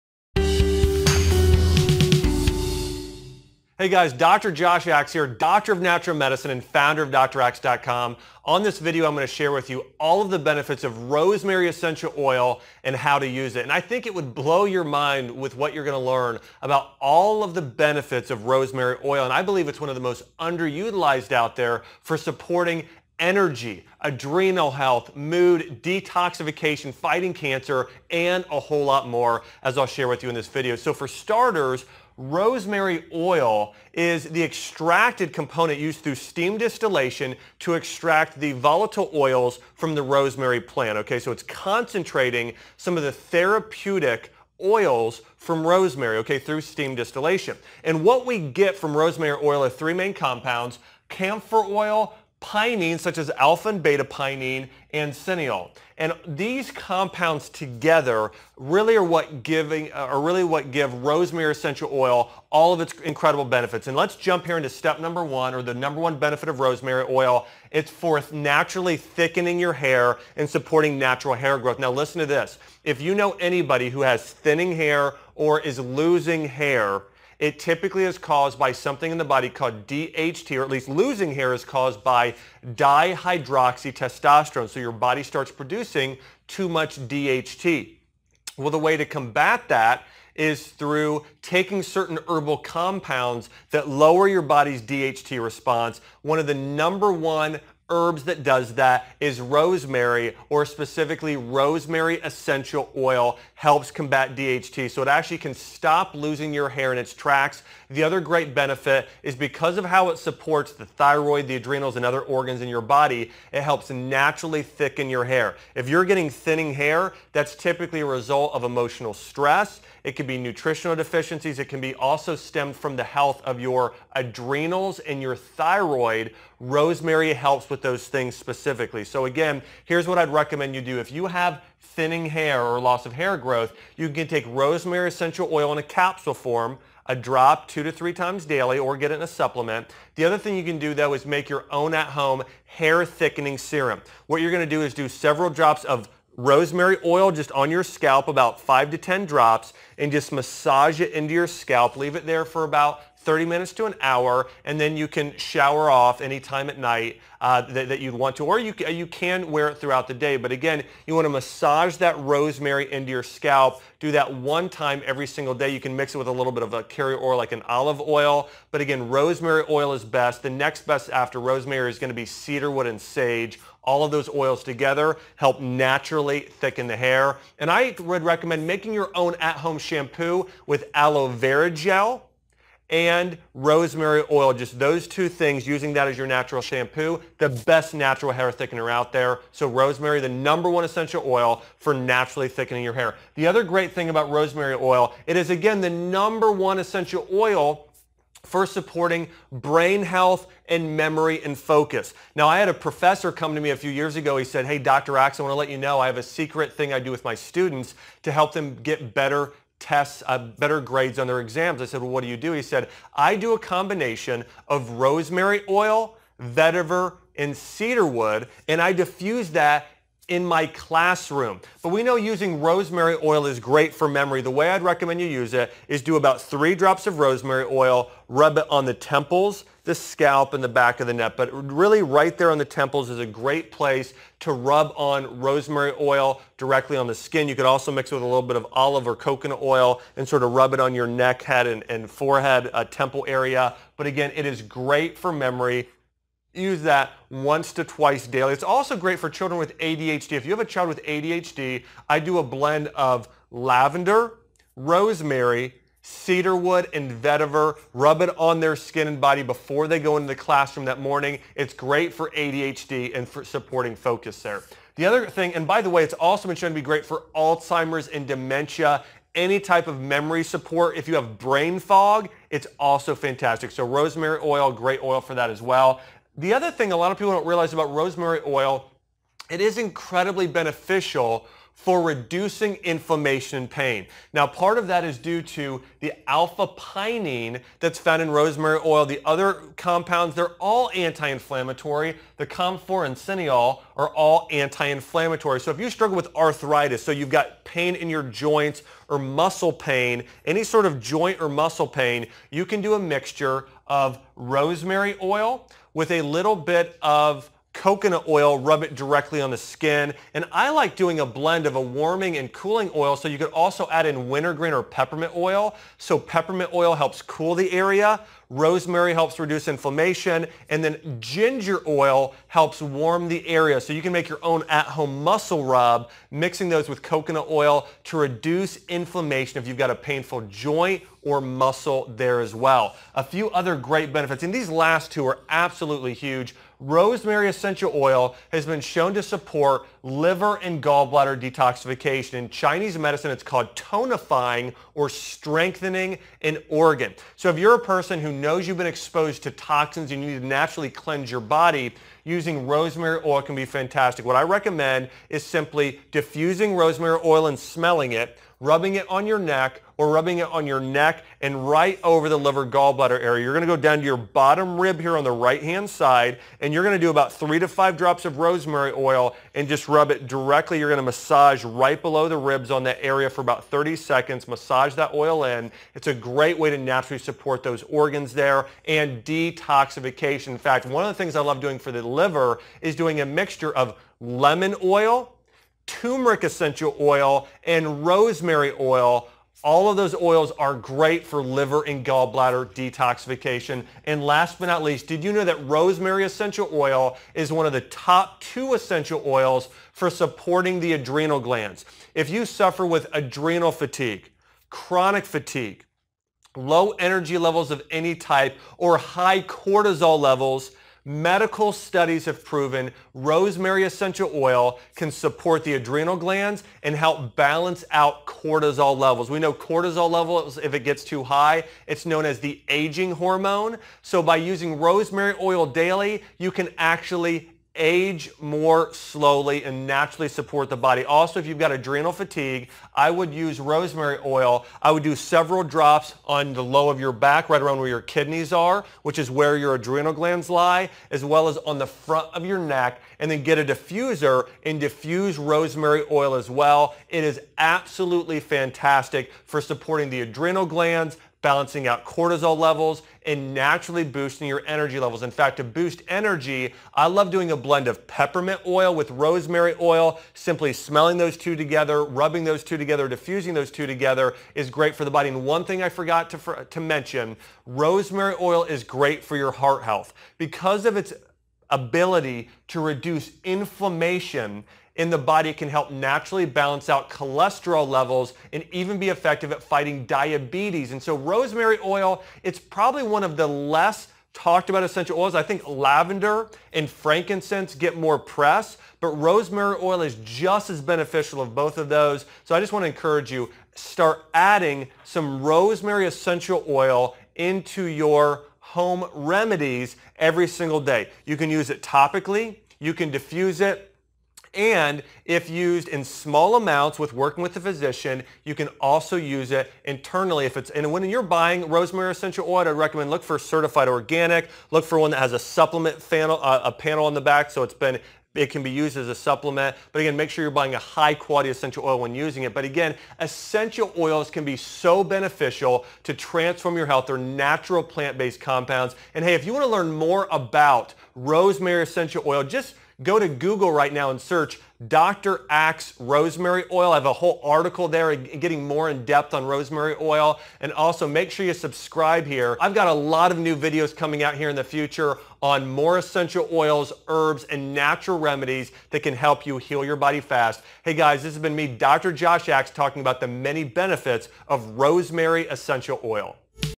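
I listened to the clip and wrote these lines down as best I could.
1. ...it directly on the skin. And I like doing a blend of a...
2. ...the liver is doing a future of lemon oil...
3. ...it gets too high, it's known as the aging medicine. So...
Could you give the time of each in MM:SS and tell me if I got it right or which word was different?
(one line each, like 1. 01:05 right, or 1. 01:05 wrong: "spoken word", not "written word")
1. 05:08 right
2. 06:21 wrong: "mixture", not "future"
3. 07:00 wrong: "hormone", not "medicine".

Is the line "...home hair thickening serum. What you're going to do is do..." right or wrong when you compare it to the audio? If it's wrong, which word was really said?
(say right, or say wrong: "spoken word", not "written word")
right.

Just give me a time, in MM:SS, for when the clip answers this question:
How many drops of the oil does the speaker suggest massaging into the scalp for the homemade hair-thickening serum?
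02:28.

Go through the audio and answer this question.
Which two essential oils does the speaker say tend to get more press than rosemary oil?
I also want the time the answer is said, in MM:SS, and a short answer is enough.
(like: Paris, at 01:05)
Lavender and frankincense, at 08:05.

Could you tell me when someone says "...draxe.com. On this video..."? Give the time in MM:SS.
00:07.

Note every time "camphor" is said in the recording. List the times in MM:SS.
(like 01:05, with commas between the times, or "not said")
00:51, 04:52.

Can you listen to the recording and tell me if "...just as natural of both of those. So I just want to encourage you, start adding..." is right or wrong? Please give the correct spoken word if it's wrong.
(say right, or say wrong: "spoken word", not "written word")
wrong: "beneficial", not "natural".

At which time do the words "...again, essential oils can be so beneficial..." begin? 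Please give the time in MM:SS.
08:42.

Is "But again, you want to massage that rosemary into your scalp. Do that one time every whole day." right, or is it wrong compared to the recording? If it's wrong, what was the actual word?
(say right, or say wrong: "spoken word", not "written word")
wrong: "single", not "whole".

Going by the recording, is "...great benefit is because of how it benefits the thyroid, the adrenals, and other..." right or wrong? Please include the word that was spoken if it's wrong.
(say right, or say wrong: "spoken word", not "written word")
wrong: "supports", not "benefits".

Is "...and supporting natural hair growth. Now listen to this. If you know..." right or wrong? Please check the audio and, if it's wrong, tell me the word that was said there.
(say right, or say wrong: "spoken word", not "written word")
right.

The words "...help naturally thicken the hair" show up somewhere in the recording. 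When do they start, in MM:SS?
02:55.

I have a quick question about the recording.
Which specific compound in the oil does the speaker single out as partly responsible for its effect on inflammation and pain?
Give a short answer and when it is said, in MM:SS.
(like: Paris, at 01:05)
Alpha pinene, at 04:46.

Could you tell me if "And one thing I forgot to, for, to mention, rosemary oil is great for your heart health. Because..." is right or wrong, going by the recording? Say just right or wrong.
right.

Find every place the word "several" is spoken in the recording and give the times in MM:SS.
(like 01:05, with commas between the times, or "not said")
02:25, 07:15.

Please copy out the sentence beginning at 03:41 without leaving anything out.
But we know using rosemary oil is great for memory.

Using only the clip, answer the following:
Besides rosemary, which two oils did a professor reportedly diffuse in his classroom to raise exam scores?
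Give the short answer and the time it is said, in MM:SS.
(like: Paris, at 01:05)
Vetiver and cedarwood, at 03:36.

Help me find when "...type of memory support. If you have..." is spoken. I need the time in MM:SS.
04:29.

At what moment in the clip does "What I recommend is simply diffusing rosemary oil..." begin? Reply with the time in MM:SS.
05:54.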